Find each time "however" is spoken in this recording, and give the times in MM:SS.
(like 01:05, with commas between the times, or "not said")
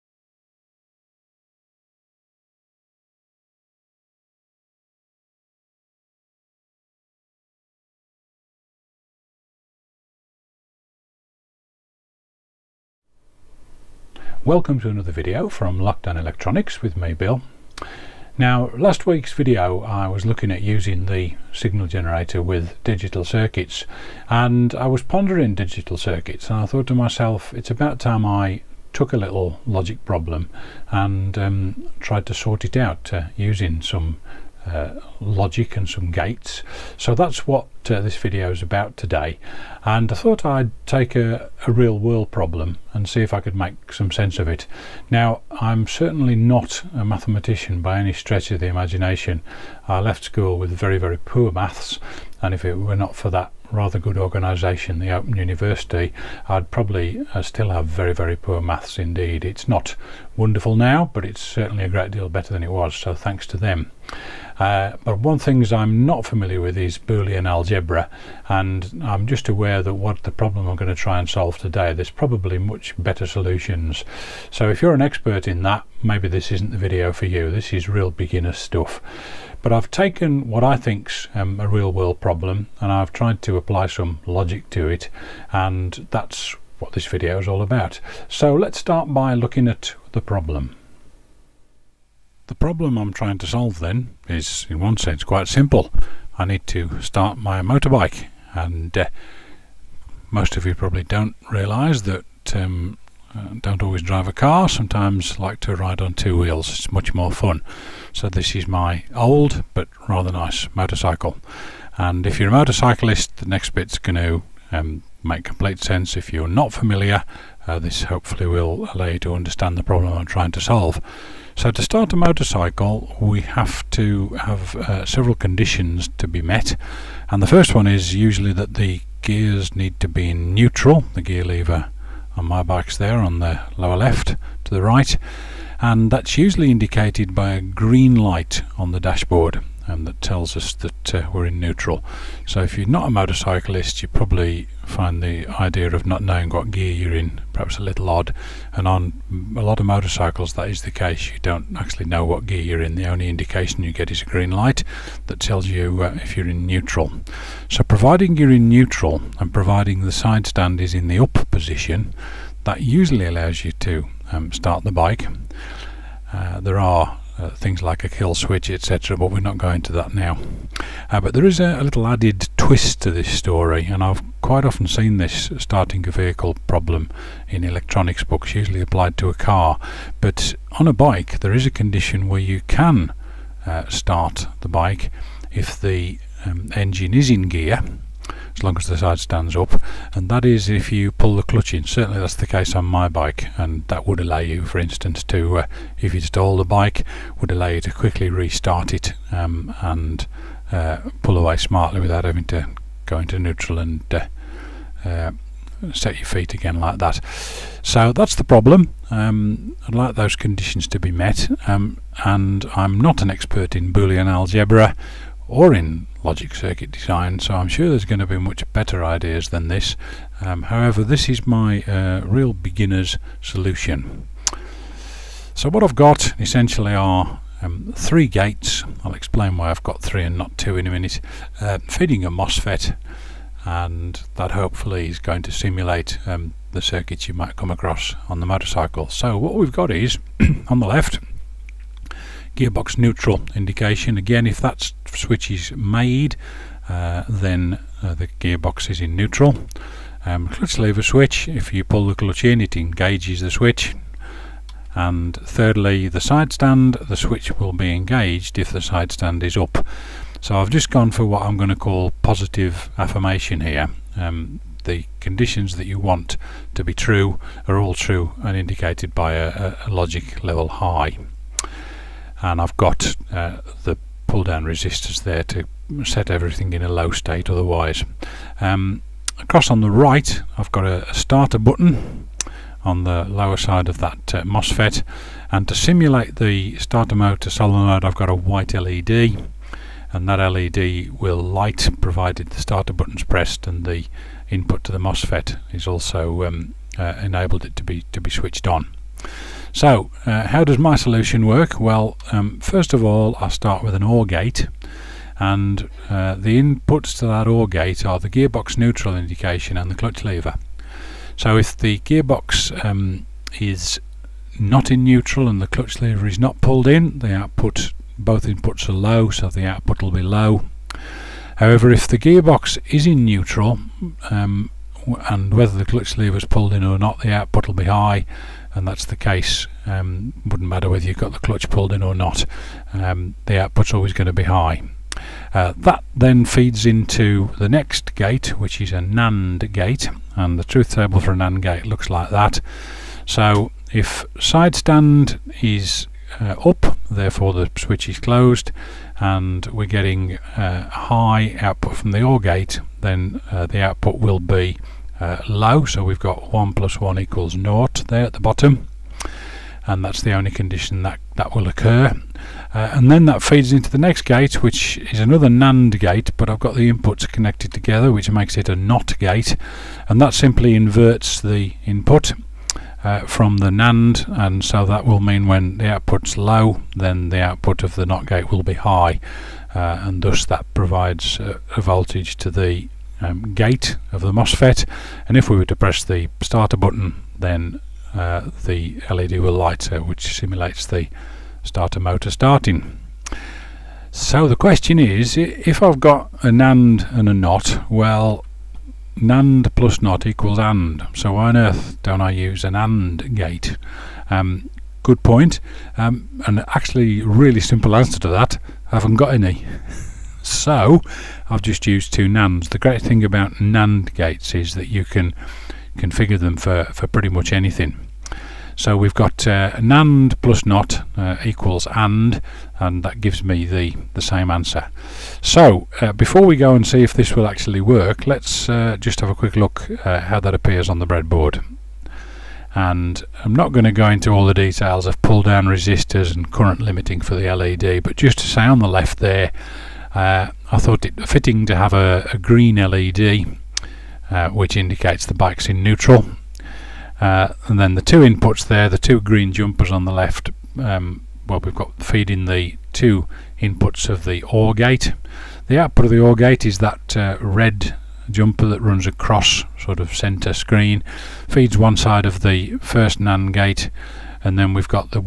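03:40, 05:21.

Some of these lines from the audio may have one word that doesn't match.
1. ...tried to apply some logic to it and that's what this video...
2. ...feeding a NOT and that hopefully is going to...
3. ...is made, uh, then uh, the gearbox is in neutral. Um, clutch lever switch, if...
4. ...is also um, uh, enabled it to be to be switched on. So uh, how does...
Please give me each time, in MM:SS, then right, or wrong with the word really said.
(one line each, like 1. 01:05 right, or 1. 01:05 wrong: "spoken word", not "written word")
1. 01:23 right
2. 03:51 wrong: "MOSFET", not "NOT"
3. 04:05 right
4. 04:55 right.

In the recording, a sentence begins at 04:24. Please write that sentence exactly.
Um, the conditions that you want to be true are all true and indicated by a, a logic level high.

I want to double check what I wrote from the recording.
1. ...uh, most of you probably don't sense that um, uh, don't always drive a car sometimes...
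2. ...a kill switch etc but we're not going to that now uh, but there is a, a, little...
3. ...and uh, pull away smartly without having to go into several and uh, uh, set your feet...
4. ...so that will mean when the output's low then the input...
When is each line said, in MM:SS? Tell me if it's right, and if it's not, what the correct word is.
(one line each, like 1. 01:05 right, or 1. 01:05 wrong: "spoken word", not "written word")
1. 01:38 wrong: "realise", not "sense"
2. 02:48 right
3. 03:19 wrong: "neutral", not "several"
4. 06:14 wrong: "output", not "input".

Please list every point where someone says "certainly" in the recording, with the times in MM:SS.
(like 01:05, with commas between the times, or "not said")
00:45, 01:01, 03:11.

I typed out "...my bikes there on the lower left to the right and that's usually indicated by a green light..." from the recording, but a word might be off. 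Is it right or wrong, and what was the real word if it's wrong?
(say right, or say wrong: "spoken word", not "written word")
right.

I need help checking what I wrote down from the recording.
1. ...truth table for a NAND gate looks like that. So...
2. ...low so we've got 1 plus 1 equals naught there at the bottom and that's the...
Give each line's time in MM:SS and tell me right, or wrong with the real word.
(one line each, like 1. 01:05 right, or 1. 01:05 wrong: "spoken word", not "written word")
1. 05:40 right
2. 05:55 right.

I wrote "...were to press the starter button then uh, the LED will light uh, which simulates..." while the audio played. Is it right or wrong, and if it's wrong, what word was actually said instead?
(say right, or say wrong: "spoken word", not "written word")
right.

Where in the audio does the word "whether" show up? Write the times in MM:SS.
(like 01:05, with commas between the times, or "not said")
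05:25, 05:30.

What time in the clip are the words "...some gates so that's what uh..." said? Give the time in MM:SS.
00:35.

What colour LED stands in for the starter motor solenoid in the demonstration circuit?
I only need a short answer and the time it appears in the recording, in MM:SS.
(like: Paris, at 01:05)
White, at 04:48.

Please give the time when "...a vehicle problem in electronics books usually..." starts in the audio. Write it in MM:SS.
02:56.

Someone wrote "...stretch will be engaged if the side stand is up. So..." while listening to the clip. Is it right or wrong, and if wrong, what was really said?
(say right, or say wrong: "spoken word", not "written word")
wrong: "switch", not "stretch".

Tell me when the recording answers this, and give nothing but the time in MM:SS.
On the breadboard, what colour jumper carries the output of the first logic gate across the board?
07:37.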